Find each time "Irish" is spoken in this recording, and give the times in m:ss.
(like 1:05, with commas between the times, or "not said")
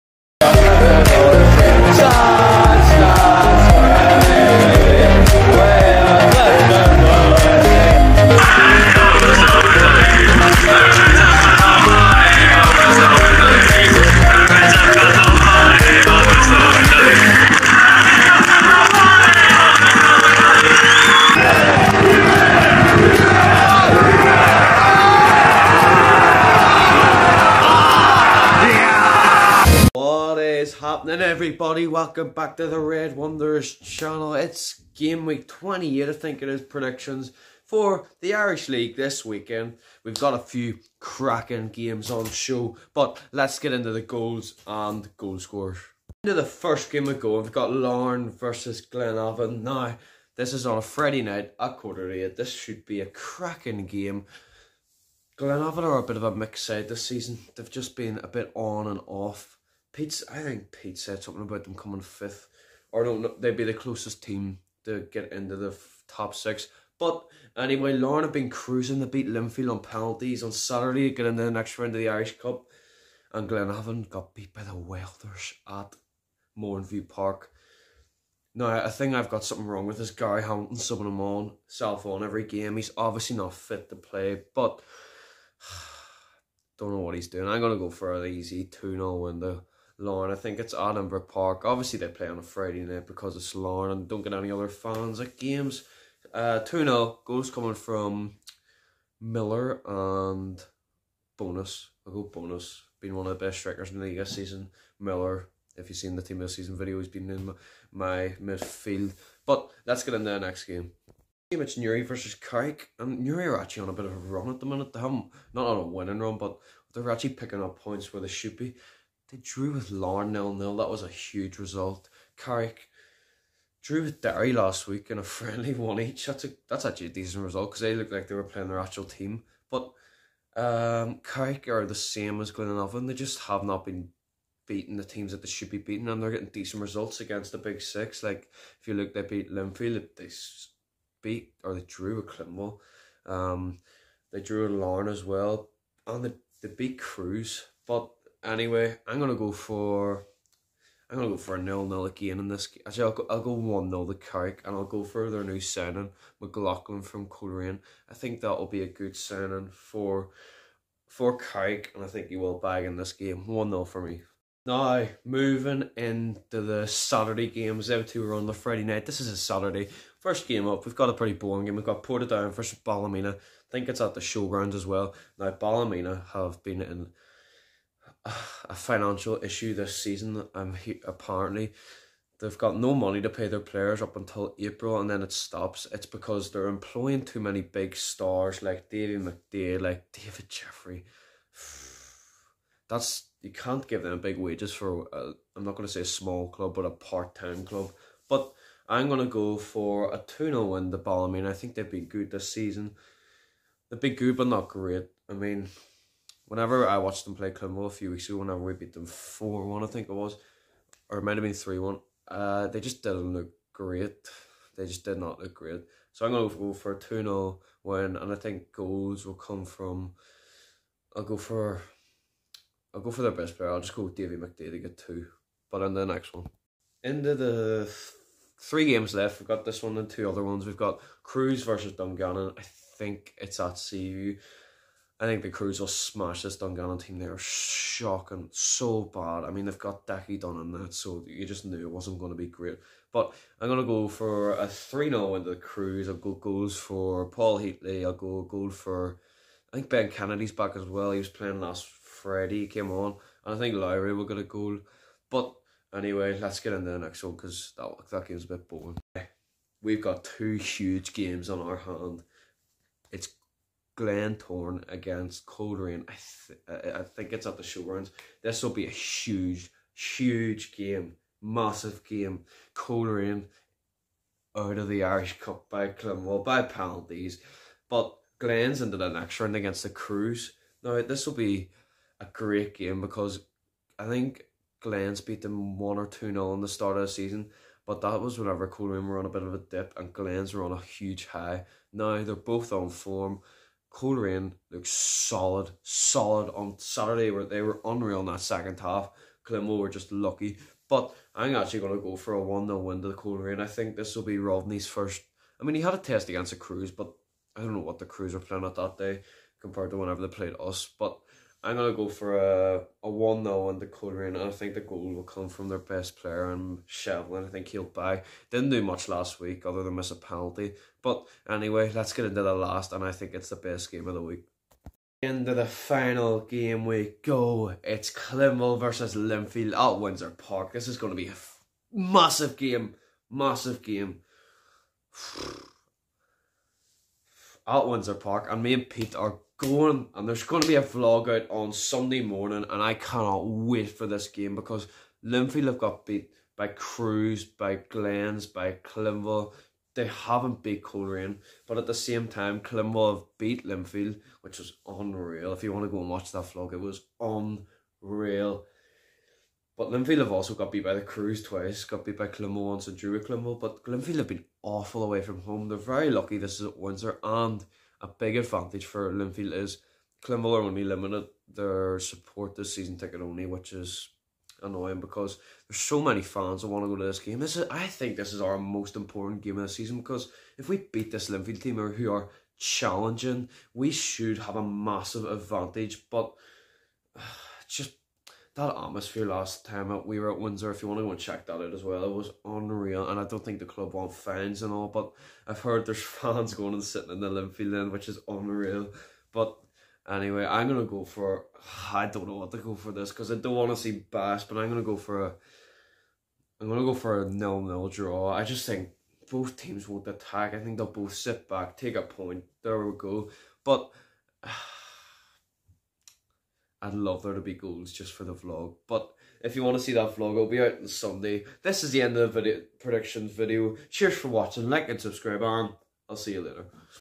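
0:38, 1:12, 4:35.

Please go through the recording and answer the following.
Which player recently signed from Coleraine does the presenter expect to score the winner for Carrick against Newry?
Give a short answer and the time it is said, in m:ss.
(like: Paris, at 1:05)
McLaughlin, at 2:36.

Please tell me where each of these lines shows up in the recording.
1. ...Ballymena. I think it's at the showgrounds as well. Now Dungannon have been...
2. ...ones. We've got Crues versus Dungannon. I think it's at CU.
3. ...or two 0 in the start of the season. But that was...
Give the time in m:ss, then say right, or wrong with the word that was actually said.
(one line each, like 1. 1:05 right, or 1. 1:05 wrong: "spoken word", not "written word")
1. 2:52 wrong: "Ballymena", not "Dungannon"
2. 3:50 right
3. 4:45 right.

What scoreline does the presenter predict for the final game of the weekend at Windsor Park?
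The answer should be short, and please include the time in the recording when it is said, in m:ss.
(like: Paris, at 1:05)
0-0, at 6:47.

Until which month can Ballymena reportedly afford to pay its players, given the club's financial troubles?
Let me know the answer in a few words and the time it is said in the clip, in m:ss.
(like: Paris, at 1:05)
April, at 3:04.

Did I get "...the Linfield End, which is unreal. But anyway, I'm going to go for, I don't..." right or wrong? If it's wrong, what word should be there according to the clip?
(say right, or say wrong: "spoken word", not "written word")
right.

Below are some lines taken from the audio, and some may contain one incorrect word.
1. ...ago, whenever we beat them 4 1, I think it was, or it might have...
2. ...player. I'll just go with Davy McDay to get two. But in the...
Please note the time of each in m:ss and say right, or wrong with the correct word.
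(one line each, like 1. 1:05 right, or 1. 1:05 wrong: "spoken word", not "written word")
1. 3:28 right
2. 3:43 right.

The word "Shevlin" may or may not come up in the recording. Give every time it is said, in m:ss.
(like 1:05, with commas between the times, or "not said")
5:16.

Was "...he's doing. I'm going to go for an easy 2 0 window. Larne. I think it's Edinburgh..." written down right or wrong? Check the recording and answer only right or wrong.
right.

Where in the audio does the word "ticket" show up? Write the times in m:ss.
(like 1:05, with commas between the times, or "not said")
6:12.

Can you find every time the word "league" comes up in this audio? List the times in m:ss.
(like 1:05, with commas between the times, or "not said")
0:38, 1:44.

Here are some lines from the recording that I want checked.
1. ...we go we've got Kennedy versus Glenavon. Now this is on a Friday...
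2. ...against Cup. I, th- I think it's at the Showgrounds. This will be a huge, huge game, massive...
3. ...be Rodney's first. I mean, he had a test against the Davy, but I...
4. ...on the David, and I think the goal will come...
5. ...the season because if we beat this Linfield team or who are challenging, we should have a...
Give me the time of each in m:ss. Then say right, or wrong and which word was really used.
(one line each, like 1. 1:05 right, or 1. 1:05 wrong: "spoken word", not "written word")
1. 0:47 wrong: "Larne", not "Kennedy"
2. 4:24 wrong: "Coleraine", not "Cup"
3. 5:04 wrong: "Crues", not "Davy"
4. 5:13 wrong: "Coleraine", not "David"
5. 6:19 right.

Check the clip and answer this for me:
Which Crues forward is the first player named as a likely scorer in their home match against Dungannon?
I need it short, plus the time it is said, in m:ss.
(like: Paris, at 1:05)
Paul Heatley, at 4:07.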